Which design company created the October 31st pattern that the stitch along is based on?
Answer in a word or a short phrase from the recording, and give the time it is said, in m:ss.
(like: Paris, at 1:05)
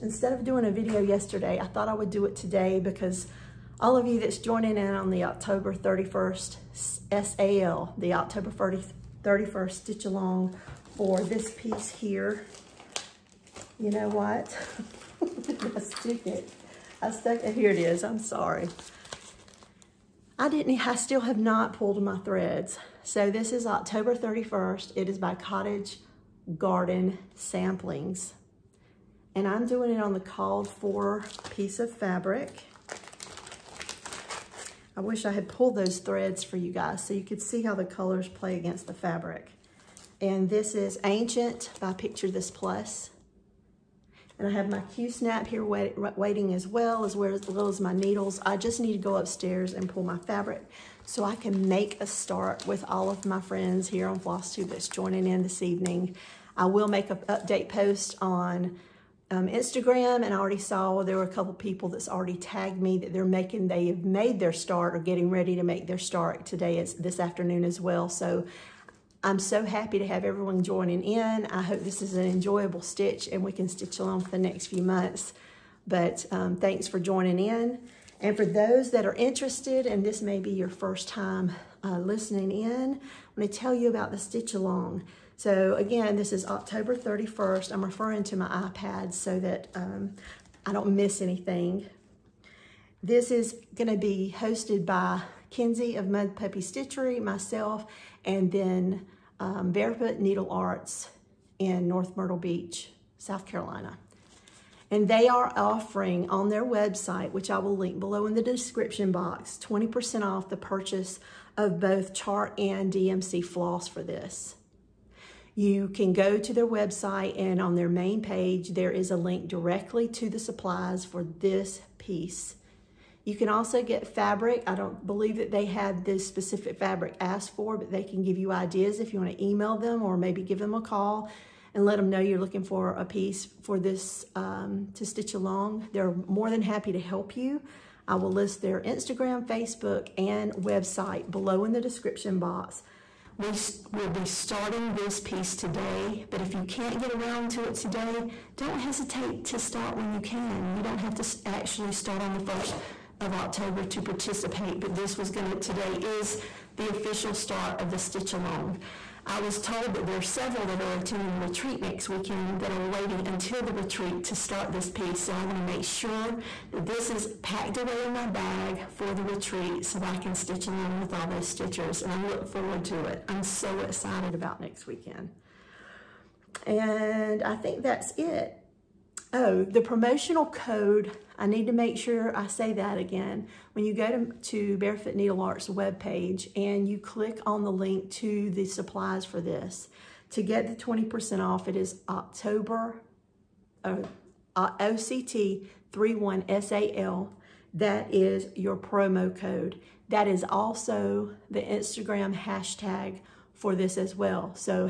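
Cottage Garden Samplings, at 0:25.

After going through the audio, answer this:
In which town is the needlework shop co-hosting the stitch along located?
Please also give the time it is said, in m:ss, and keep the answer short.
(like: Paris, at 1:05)
North Myrtle Beach, at 1:41.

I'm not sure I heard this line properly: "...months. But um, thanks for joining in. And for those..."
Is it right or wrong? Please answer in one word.
right.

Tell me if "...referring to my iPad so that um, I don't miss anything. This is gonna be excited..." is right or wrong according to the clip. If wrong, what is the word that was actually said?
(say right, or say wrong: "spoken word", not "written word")
wrong: "hosted", not "excited".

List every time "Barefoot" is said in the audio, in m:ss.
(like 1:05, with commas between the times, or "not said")
1:39, 3:04.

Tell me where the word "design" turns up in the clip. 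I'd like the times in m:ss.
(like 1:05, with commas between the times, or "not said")
not said.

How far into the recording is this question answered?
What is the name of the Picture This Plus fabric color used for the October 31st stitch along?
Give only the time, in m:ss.
0:41.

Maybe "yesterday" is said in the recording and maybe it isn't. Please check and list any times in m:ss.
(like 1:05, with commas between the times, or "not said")
0:01.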